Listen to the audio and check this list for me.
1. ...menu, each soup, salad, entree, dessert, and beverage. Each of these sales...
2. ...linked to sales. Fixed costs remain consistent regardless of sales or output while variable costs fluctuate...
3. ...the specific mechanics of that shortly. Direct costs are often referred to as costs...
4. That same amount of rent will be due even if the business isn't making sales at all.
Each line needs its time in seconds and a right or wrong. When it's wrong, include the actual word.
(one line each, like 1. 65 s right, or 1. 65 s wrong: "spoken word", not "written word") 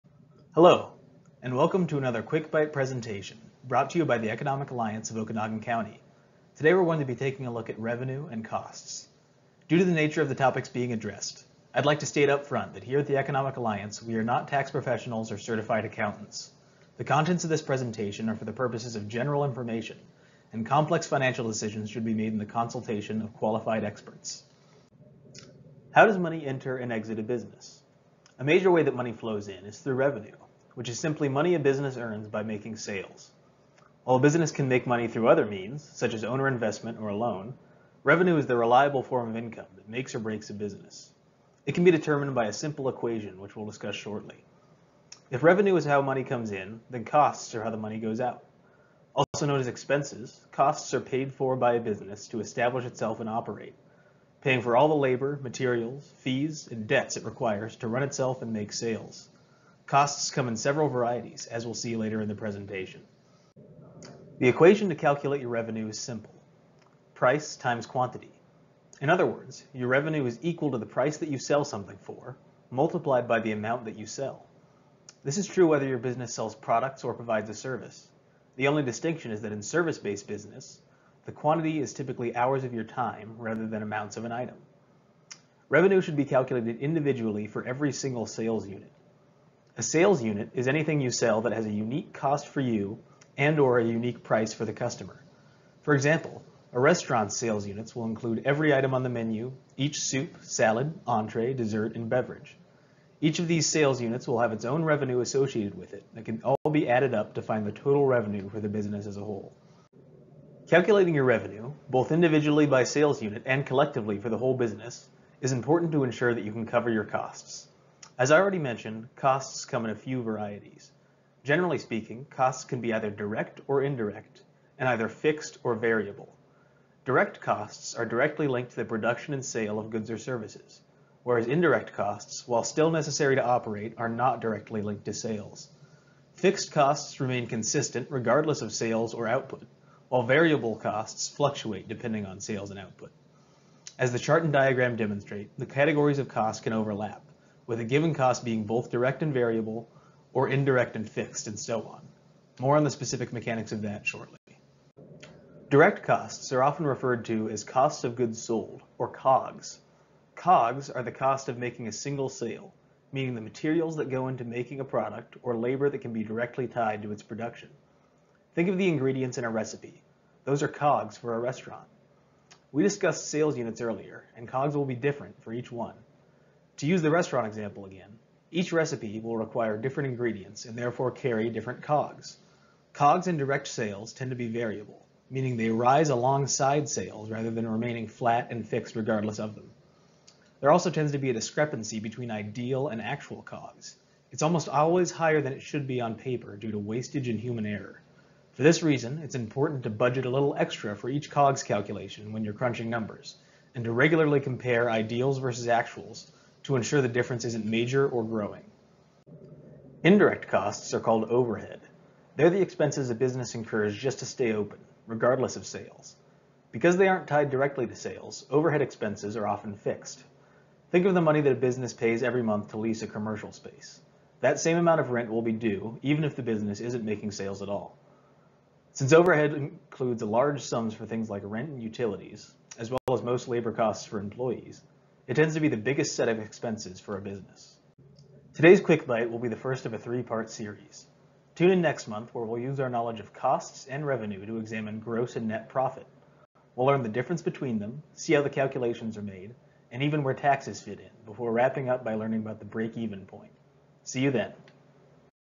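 1. 99 s right
2. 134 s right
3. 152 s right
4. 224 s right.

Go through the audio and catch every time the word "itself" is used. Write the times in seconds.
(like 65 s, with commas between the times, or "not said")
52 s, 58 s.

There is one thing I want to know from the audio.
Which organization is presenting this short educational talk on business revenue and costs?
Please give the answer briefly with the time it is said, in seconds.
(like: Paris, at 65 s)
Economic Alliance of Okanogan County, at 4 s.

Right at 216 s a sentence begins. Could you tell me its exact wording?
Because they aren't tied directly to sales, overhead expenses are often fixed.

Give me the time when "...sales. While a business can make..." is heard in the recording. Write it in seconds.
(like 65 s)
32 s.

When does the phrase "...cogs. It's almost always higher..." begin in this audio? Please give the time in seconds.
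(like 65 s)
193 s.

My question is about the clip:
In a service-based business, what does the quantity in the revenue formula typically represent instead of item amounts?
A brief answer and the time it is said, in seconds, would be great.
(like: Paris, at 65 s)
hours of your time, at 82 s.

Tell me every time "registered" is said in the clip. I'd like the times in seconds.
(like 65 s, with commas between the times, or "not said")
not said.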